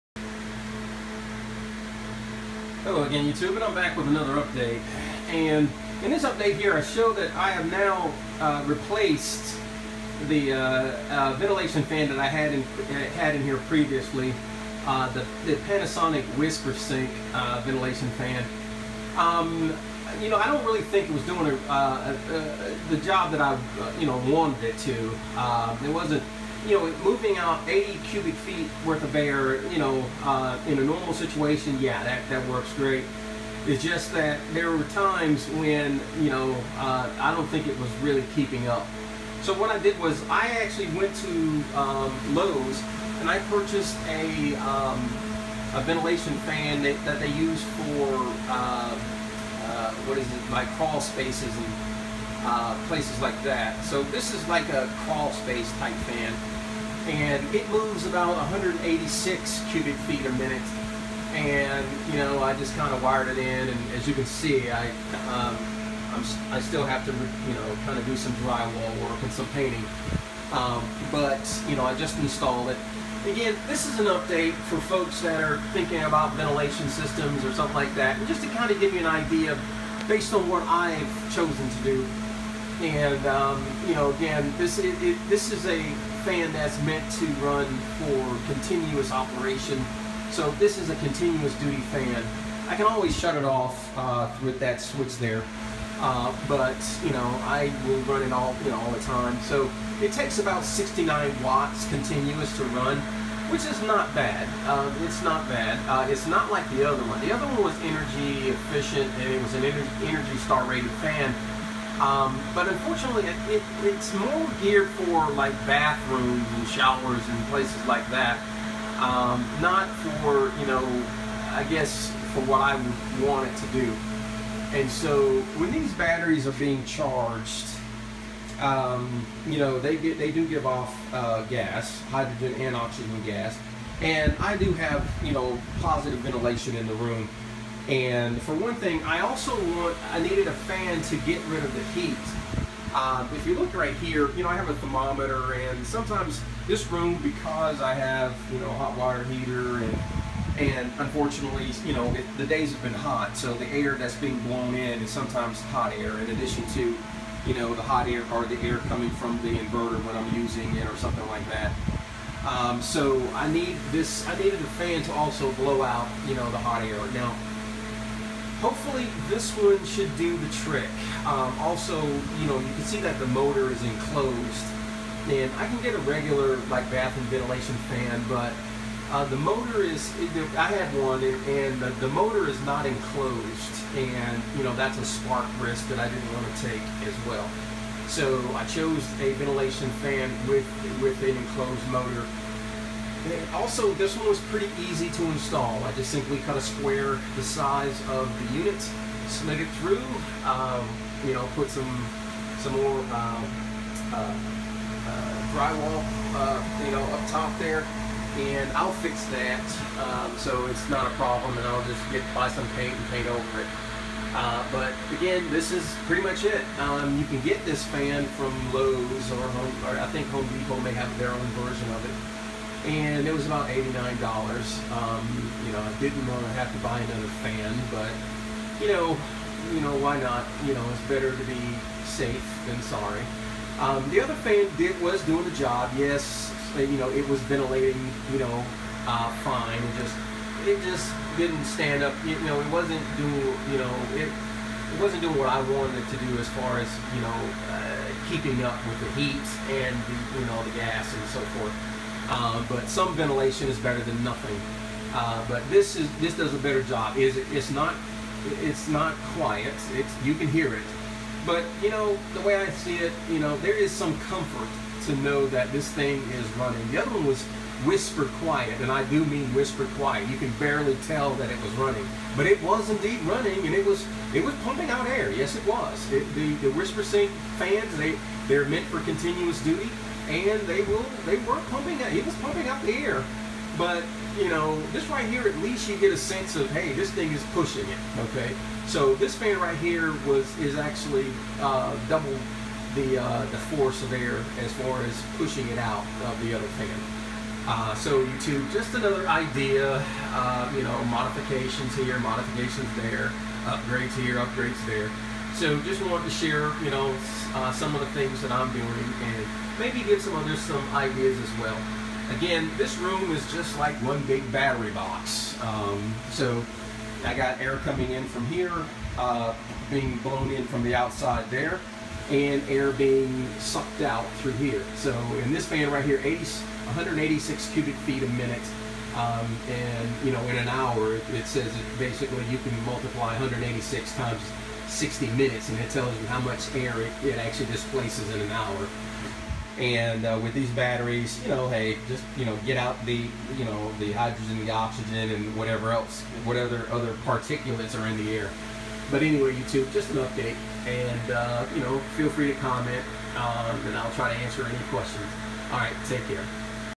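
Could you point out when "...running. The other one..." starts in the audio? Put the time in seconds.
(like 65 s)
266 s.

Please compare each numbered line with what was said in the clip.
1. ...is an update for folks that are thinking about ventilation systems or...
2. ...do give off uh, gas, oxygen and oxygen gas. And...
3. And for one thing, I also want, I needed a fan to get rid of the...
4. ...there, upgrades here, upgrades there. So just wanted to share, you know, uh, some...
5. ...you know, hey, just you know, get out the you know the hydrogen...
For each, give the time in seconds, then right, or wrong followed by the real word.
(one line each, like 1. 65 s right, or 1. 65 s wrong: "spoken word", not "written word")
1. 73 s right
2. 130 s wrong: "hydrogen", not "oxygen"
3. 137 s right
4. 302 s right
5. 341 s right.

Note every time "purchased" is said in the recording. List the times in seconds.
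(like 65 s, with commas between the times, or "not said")
43 s.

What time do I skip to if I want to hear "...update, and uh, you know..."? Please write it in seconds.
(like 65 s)
350 s.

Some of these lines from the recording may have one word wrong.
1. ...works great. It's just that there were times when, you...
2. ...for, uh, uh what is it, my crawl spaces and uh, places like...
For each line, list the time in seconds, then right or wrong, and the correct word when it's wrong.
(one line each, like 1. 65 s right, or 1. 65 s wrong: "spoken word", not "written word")
1. 32 s right
2. 47 s right.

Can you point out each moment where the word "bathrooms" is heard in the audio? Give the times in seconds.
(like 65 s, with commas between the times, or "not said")
115 s, 176 s.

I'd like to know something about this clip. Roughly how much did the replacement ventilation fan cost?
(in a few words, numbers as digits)
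$89.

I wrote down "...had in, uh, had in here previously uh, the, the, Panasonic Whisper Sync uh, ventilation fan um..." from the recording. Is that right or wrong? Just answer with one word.
right.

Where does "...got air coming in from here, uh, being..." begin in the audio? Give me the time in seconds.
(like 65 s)
317 s.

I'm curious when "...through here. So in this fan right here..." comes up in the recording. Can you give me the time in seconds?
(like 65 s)
324 s.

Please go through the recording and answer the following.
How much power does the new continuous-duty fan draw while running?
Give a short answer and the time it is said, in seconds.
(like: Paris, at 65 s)
69 watts, at 100 s.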